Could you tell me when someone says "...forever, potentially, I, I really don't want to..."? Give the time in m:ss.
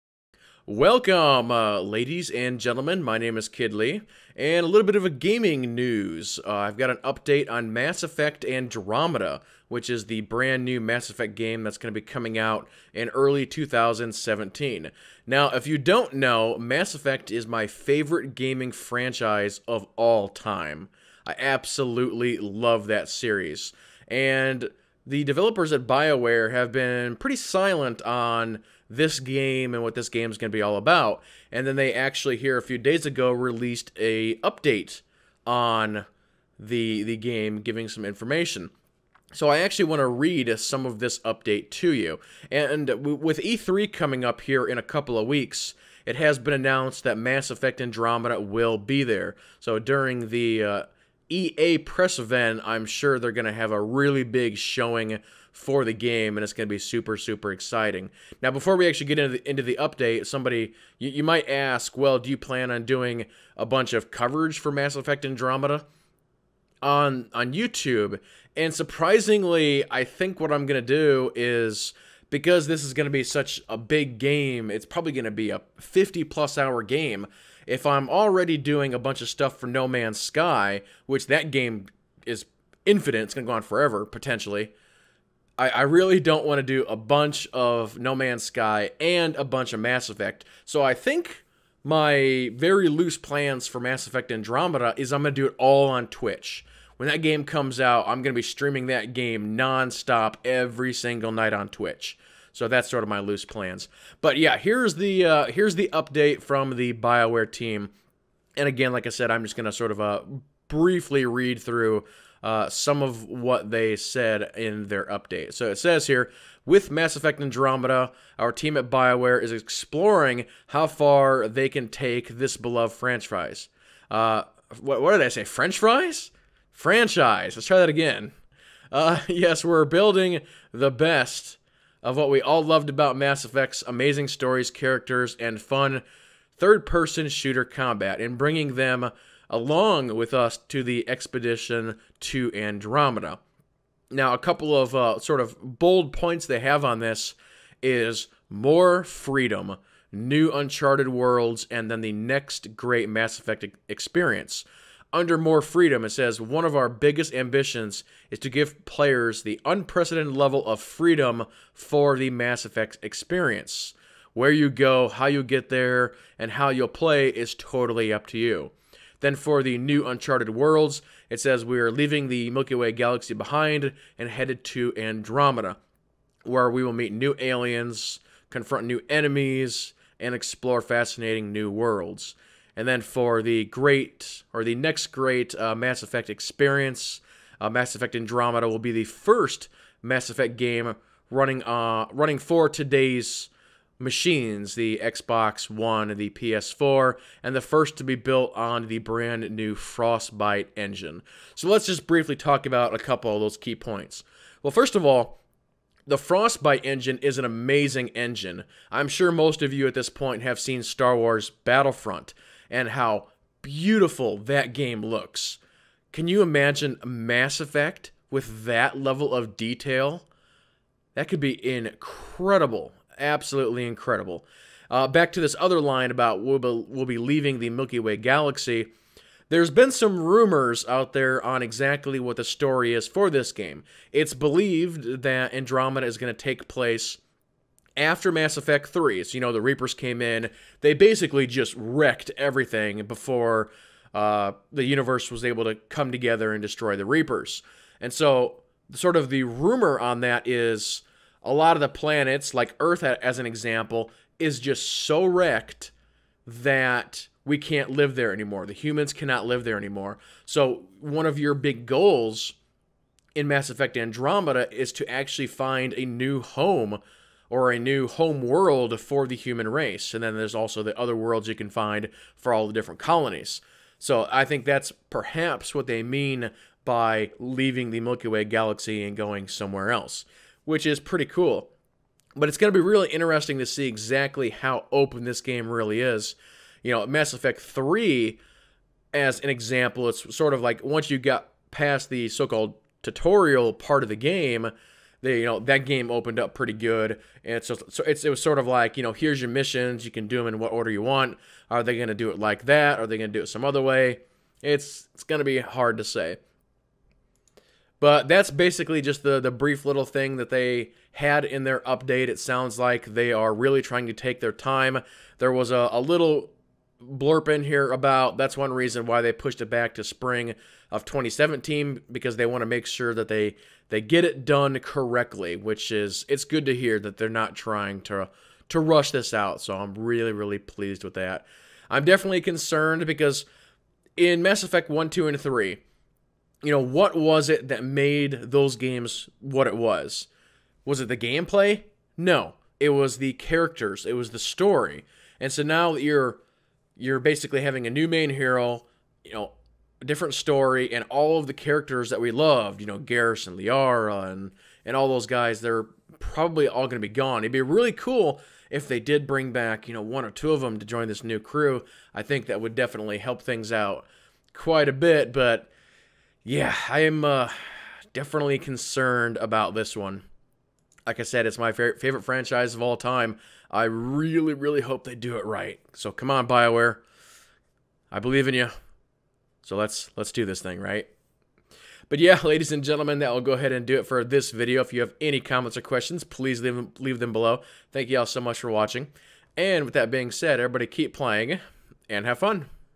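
1:23.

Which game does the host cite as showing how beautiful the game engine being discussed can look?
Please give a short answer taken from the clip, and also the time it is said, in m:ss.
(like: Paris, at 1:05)
Star Wars Battlefront, at 3:30.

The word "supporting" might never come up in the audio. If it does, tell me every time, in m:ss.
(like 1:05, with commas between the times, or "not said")
not said.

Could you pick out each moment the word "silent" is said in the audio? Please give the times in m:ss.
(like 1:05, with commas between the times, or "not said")
0:27.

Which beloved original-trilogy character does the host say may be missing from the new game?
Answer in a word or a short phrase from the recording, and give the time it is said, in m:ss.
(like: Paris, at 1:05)
Liara, at 5:53.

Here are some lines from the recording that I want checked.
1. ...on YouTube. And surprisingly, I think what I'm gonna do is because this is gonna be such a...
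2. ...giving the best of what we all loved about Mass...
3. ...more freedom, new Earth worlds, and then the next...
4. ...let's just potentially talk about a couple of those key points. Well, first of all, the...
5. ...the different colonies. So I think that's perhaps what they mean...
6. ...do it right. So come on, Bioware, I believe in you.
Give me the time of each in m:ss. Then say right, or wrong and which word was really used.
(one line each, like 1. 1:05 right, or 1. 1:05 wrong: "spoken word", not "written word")
1. 1:07 right
2. 2:09 wrong: "building", not "giving"
3. 2:28 wrong: "Uncharted", not "Earth"
4. 3:21 wrong: "briefly", not "potentially"
5. 4:32 right
6. 6:15 right.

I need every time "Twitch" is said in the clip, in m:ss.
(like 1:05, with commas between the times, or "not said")
1:36, 1:41.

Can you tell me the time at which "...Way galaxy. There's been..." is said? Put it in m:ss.
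3:47.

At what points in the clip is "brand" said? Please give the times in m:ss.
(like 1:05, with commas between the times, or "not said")
0:10, 3:18.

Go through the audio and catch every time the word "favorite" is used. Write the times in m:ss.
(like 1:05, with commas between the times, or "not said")
0:17, 6:11.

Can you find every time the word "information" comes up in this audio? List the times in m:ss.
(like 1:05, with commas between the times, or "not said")
0:38.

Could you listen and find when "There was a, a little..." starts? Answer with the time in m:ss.
5:15.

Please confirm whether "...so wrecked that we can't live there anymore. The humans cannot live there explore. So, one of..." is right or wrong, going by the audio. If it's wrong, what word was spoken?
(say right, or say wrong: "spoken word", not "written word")
wrong: "anymore", not "explore".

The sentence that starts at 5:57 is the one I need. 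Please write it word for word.
It'd be really cool if they did bring back, you know, one or two of them to join this new crew.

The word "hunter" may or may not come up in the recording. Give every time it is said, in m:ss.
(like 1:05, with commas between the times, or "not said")
not said.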